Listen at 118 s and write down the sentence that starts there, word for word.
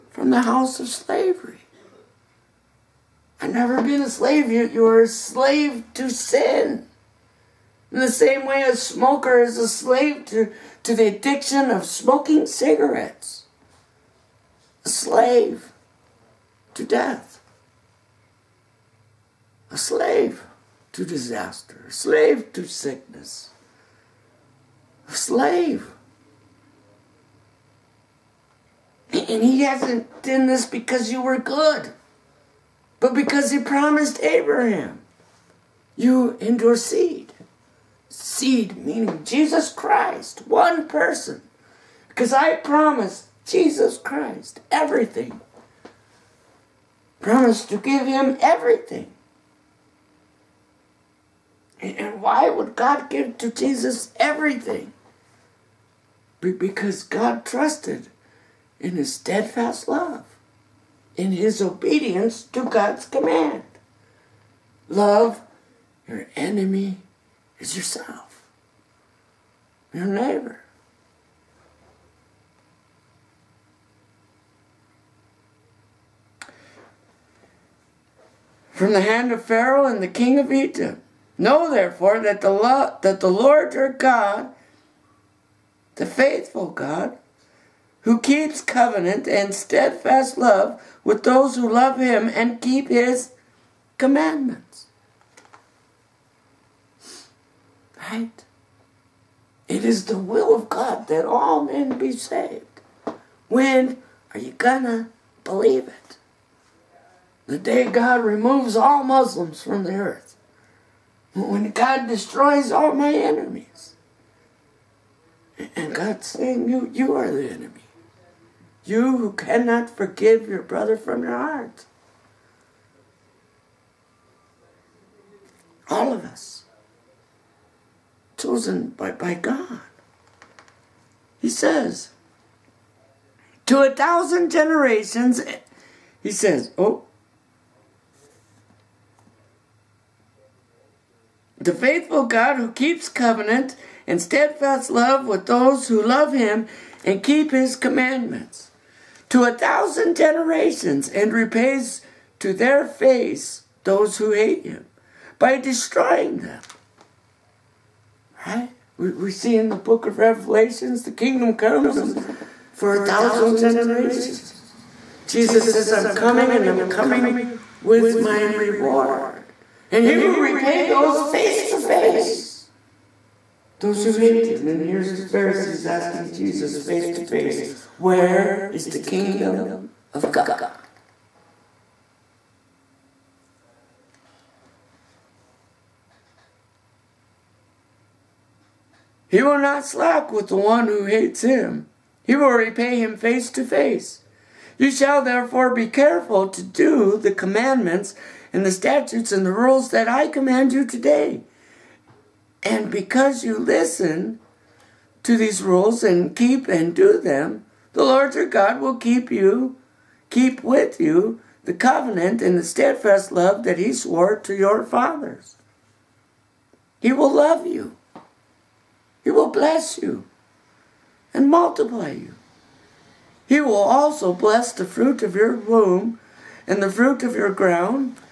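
You who cannot forgive your brother from your heart.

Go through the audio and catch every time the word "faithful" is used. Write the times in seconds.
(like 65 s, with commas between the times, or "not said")
86 s, 141 s.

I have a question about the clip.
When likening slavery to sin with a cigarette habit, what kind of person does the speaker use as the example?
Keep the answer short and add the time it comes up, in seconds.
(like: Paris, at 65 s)
A smoker, at 8 s.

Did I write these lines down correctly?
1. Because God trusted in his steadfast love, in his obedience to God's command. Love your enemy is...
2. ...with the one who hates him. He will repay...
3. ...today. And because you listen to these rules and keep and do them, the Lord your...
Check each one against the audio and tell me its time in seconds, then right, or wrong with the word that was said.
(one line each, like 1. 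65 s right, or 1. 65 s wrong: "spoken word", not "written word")
1. 56 s right
2. 190 s right
3. 200 s right.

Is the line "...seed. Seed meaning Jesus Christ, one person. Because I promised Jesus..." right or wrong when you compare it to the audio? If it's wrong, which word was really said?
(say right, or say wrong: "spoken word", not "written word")
right.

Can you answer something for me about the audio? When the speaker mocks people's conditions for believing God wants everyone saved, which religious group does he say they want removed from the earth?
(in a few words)
Muslims.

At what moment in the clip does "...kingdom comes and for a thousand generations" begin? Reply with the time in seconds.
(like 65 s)
161 s.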